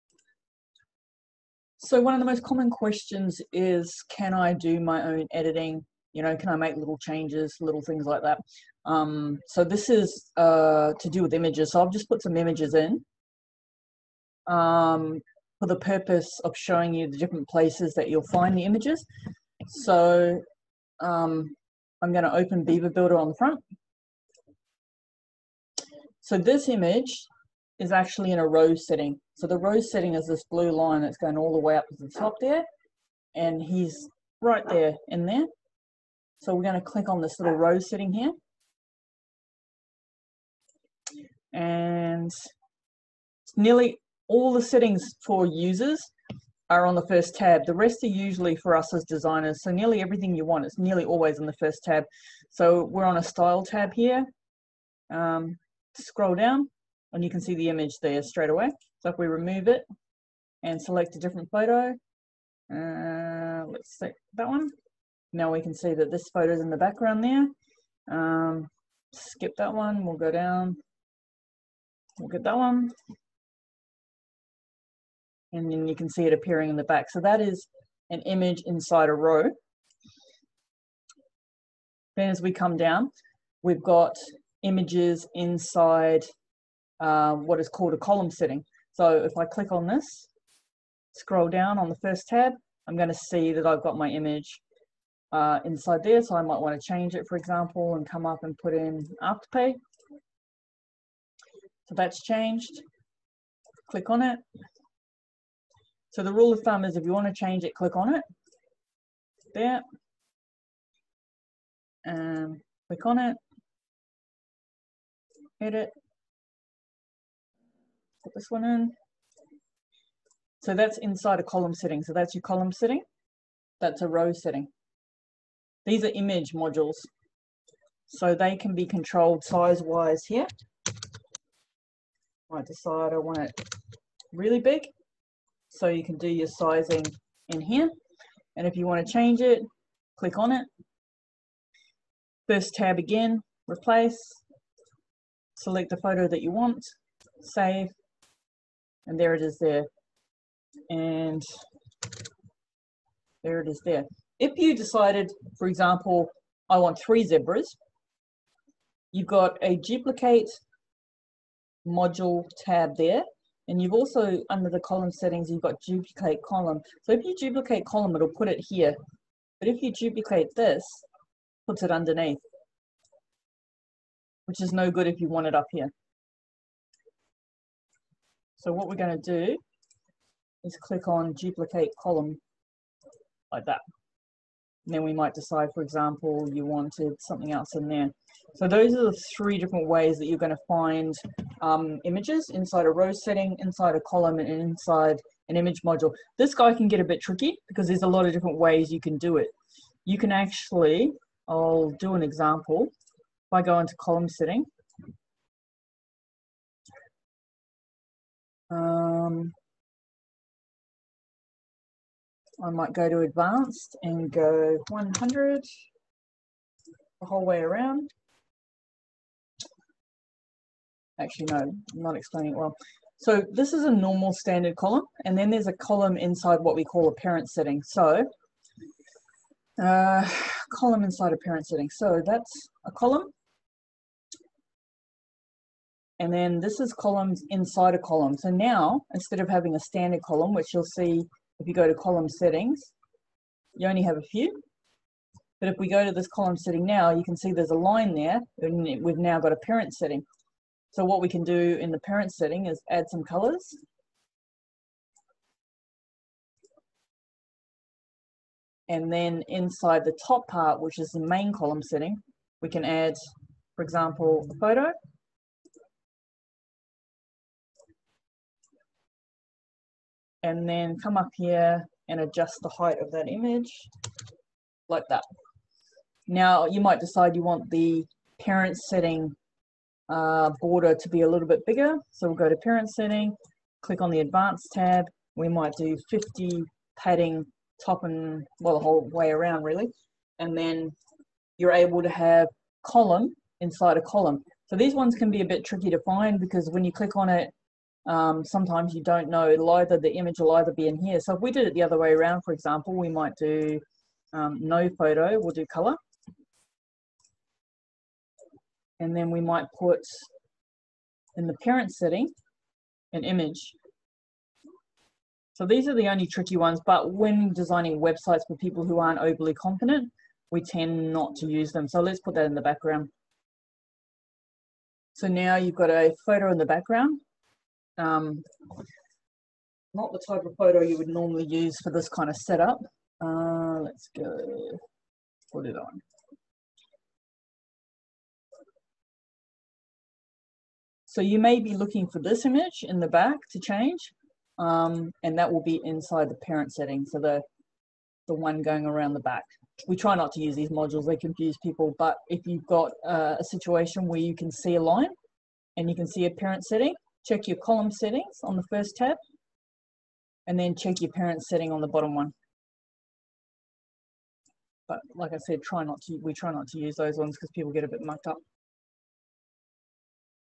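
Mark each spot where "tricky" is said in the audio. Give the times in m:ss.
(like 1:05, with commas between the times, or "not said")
3:17, 4:55, 5:16.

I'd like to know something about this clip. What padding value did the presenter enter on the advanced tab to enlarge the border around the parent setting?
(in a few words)
50.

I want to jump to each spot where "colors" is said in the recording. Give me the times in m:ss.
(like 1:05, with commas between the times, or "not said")
4:13, 5:05.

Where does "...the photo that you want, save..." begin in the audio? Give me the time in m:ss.
2:25.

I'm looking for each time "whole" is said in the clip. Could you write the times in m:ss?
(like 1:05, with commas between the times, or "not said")
3:37, 4:48.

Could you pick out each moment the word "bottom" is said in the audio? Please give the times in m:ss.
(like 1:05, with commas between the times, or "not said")
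6:01.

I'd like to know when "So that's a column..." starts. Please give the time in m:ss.
3:51.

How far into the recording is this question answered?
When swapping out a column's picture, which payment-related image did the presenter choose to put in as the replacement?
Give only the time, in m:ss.
1:39.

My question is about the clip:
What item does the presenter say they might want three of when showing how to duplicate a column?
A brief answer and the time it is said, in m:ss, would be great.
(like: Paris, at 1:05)
Zebras, at 2:37.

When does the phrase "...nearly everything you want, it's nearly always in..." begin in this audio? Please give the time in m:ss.
0:49.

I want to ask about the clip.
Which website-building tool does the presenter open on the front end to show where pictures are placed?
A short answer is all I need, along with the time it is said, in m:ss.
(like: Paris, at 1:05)
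Beaver Builder, at 0:22.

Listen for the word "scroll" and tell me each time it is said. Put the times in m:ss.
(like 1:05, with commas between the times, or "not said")
0:55, 1:31.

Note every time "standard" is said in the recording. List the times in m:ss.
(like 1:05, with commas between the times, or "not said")
3:44, 3:59.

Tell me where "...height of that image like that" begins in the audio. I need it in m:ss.
4:32.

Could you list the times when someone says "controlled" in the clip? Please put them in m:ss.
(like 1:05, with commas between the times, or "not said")
2:08.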